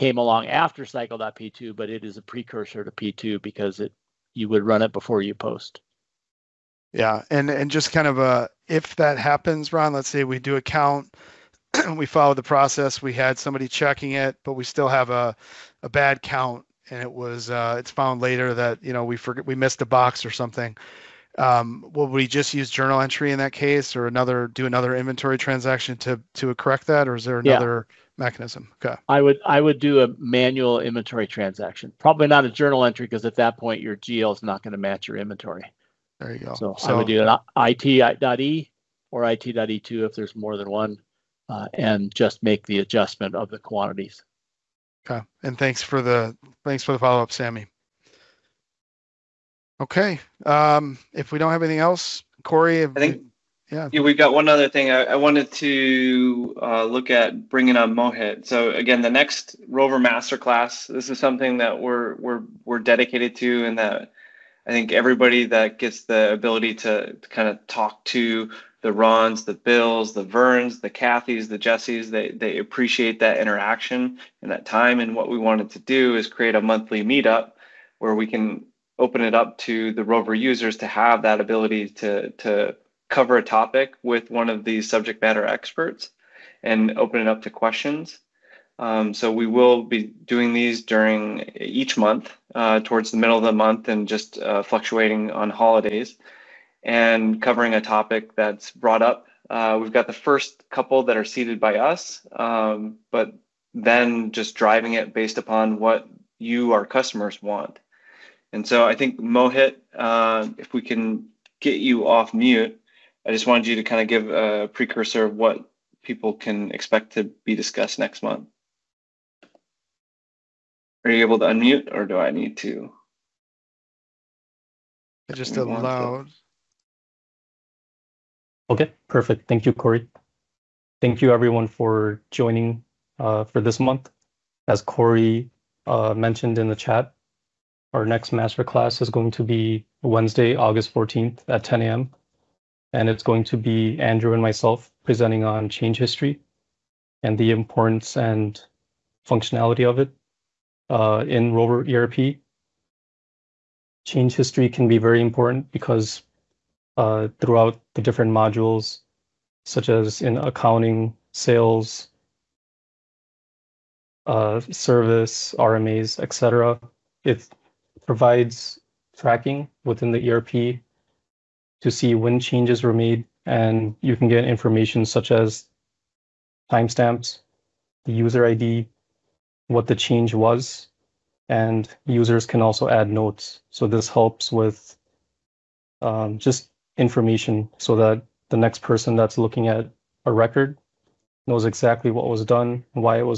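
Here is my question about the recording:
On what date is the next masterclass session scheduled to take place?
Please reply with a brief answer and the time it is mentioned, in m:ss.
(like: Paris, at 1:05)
Wednesday, August 14th, at 2:20.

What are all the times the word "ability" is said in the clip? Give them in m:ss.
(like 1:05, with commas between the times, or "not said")
1:06, 1:21.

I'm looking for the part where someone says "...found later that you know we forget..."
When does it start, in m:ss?
0:17.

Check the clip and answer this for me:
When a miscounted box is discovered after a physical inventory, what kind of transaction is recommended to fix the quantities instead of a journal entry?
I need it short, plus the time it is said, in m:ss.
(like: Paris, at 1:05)
manual inventory transaction, at 0:30.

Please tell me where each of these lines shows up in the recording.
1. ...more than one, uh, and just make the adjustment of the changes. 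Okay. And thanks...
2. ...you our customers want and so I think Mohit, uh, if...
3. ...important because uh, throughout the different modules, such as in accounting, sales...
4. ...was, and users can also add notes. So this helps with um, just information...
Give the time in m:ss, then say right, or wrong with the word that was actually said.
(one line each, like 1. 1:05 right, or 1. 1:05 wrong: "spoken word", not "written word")
1. 0:40 wrong: "quantities", not "changes"
2. 1:46 right
3. 2:35 right
4. 3:00 right.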